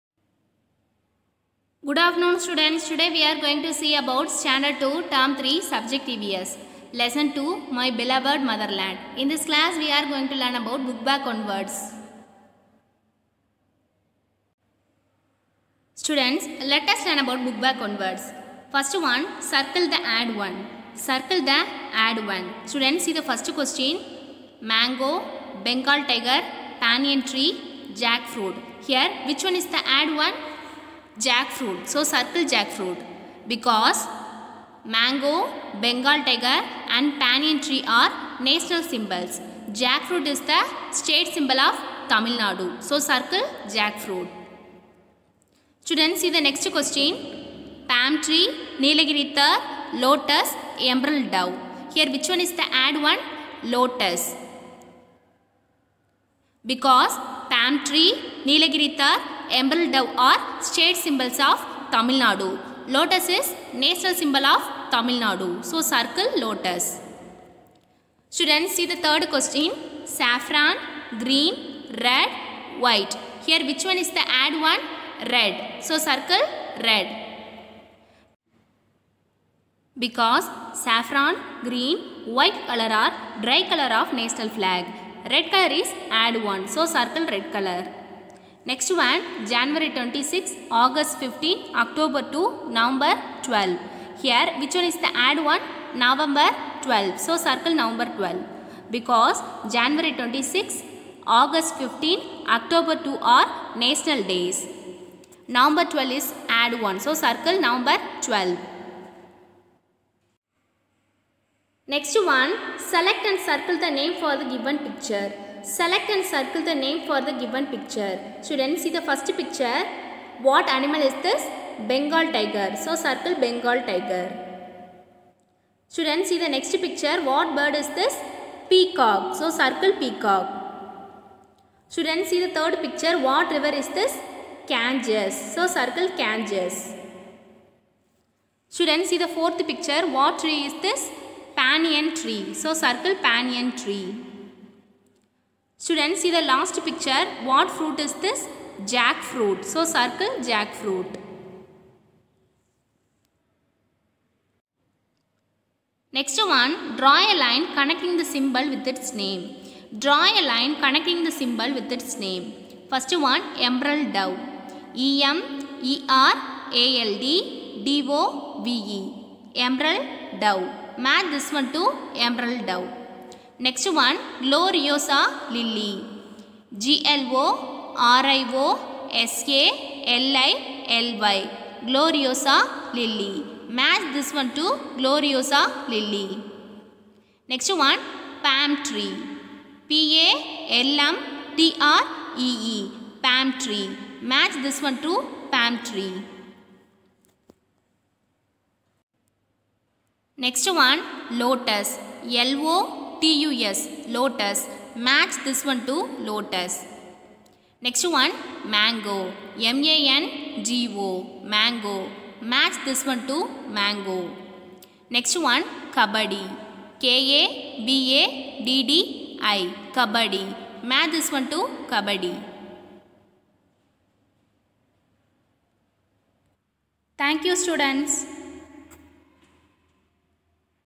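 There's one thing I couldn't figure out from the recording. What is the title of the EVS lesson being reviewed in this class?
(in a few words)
My Beloved Motherland.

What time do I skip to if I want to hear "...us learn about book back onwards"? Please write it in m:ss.
0:16.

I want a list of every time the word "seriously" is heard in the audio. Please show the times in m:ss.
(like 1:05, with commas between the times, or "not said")
not said.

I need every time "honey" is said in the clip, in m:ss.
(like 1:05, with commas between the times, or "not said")
not said.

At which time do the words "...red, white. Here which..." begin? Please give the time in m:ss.
1:12.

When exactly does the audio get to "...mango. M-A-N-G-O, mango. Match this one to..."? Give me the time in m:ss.
3:28.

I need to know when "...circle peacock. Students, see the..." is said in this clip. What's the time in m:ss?
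2:09.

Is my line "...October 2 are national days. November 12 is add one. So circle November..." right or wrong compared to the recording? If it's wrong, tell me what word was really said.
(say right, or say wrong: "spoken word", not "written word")
right.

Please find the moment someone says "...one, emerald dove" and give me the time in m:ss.
2:43.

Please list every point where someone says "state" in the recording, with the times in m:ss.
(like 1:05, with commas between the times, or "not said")
0:40, 1:00.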